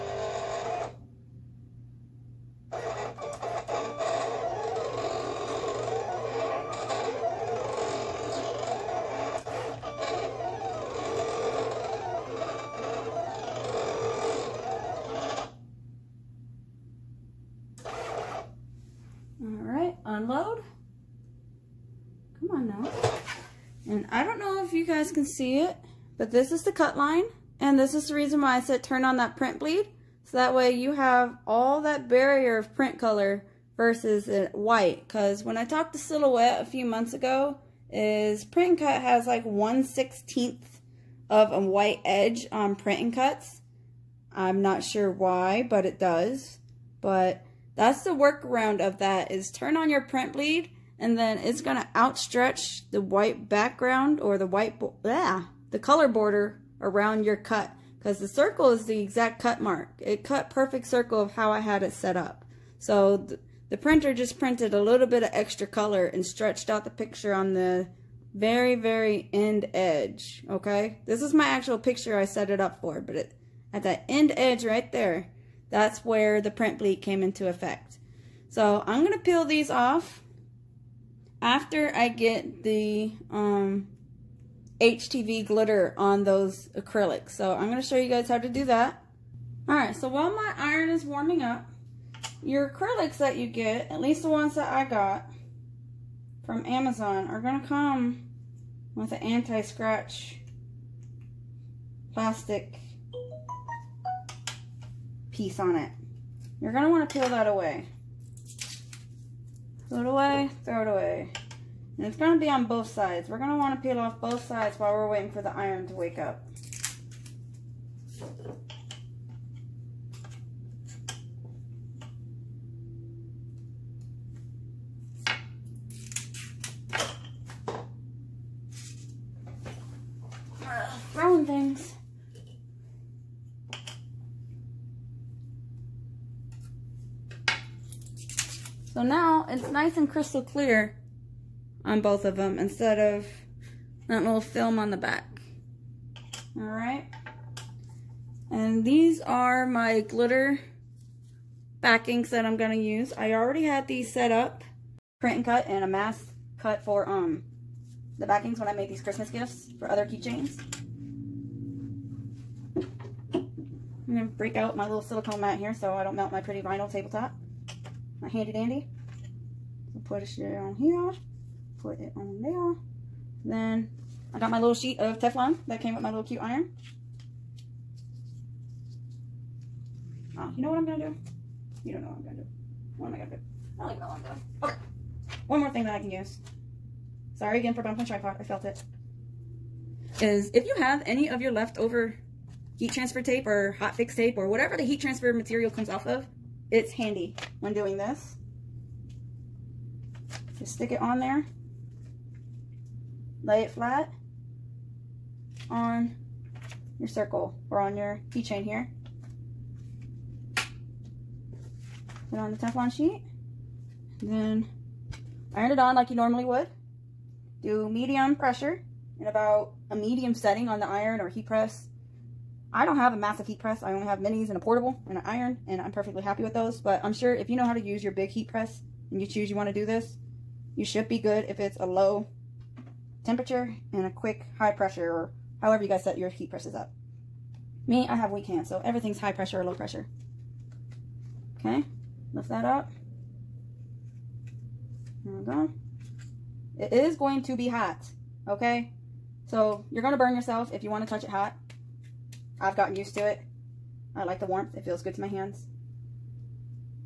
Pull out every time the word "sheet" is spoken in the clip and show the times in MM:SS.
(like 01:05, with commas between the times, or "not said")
02:54, 03:32.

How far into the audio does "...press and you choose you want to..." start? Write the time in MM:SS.
03:48.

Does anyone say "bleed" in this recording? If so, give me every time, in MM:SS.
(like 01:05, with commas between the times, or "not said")
00:29, 00:50, 01:16.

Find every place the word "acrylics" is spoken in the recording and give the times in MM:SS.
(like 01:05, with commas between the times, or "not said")
01:26, 01:32.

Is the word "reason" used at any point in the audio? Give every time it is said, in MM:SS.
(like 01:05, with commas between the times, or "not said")
00:28.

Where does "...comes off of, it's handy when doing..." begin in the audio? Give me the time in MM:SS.
03:15.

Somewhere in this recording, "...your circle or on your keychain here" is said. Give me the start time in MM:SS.
03:26.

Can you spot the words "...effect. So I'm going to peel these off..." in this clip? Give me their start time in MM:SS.
01:17.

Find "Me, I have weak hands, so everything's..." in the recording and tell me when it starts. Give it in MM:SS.
03:57.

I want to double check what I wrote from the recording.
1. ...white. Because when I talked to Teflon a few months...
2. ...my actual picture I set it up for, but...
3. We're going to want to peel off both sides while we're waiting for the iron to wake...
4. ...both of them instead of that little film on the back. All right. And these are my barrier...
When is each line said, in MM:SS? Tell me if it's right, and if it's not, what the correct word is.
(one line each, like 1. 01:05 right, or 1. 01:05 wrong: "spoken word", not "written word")
1. 00:34 wrong: "Silhouette", not "Teflon"
2. 01:11 right
3. 01:53 right
4. 02:22 wrong: "glitter", not "barrier".